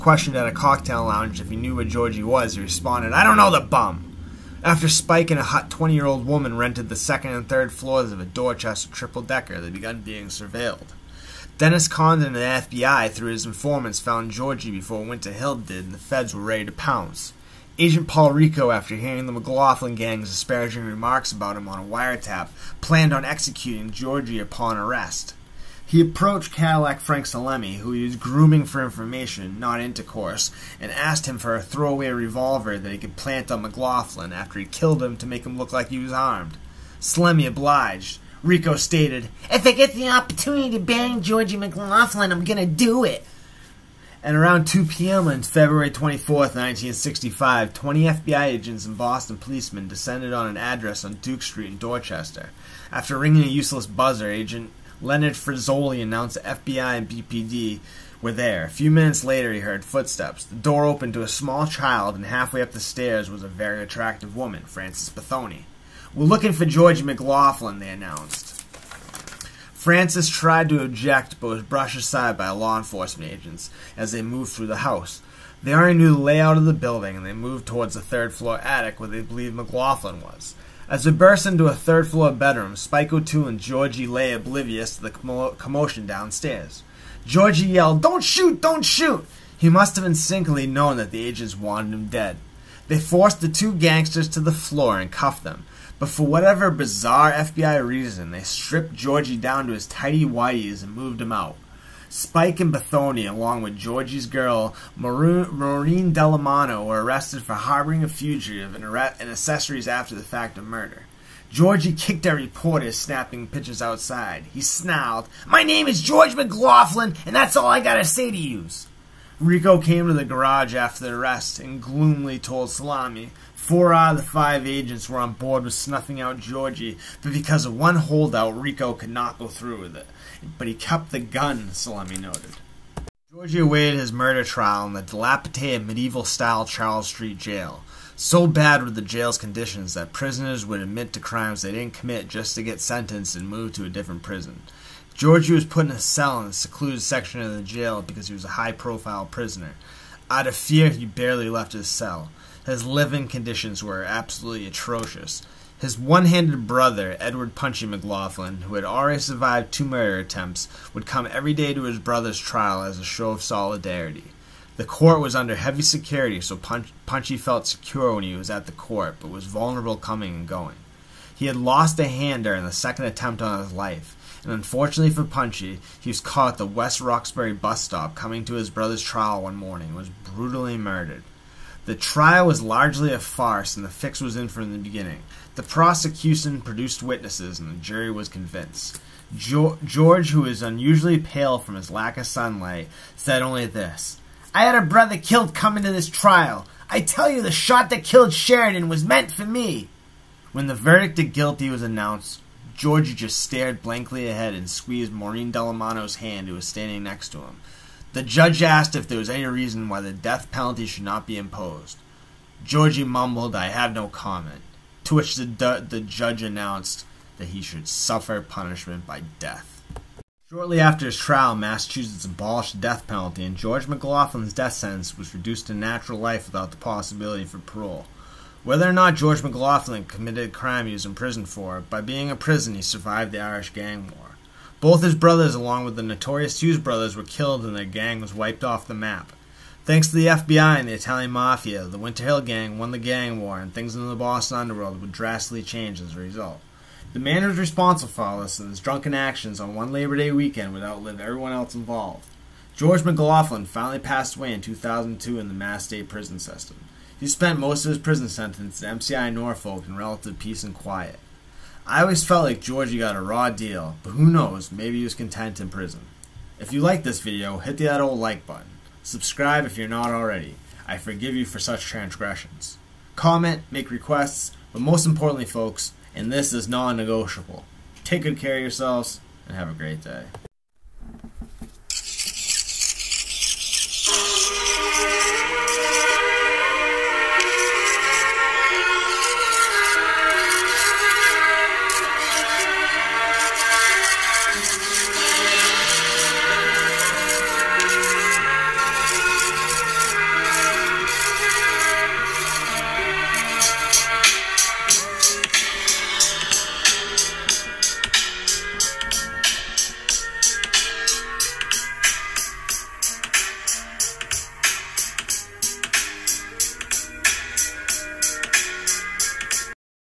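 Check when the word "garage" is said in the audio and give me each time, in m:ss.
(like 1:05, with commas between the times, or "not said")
2:00.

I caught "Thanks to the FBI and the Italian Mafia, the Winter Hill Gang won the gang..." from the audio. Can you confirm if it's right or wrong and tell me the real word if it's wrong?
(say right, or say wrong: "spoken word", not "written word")
right.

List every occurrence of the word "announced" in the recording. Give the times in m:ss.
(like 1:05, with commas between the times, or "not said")
0:56, 1:07, 3:21, 3:36.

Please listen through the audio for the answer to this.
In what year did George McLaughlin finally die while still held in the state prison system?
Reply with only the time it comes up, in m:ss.
4:14.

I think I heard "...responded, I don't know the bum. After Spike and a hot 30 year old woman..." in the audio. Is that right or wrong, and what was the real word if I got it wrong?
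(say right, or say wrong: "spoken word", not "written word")
wrong: "20", not "30".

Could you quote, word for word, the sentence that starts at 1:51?
Georgie kicked at reporters snapping pictures outside.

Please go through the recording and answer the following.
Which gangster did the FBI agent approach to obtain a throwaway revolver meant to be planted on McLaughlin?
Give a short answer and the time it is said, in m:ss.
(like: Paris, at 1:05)
Cadillac Frank Salemme, at 0:26.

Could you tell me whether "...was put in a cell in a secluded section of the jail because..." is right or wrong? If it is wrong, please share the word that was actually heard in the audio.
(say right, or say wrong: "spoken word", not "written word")
right.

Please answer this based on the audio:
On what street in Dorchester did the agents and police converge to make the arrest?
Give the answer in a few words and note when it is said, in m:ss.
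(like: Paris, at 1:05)
Duke Street, at 0:51.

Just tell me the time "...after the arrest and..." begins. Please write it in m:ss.
2:00.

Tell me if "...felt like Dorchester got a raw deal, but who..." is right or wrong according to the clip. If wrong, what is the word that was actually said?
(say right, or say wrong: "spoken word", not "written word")
wrong: "Georgie", not "Dorchester".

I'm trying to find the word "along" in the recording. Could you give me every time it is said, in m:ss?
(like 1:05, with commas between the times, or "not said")
1:43, 3:55.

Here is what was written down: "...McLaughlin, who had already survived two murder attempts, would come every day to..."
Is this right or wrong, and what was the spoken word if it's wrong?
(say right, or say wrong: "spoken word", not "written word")
right.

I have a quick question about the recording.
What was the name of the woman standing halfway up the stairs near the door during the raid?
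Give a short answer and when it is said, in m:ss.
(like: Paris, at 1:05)
Frances Bethony, at 1:04.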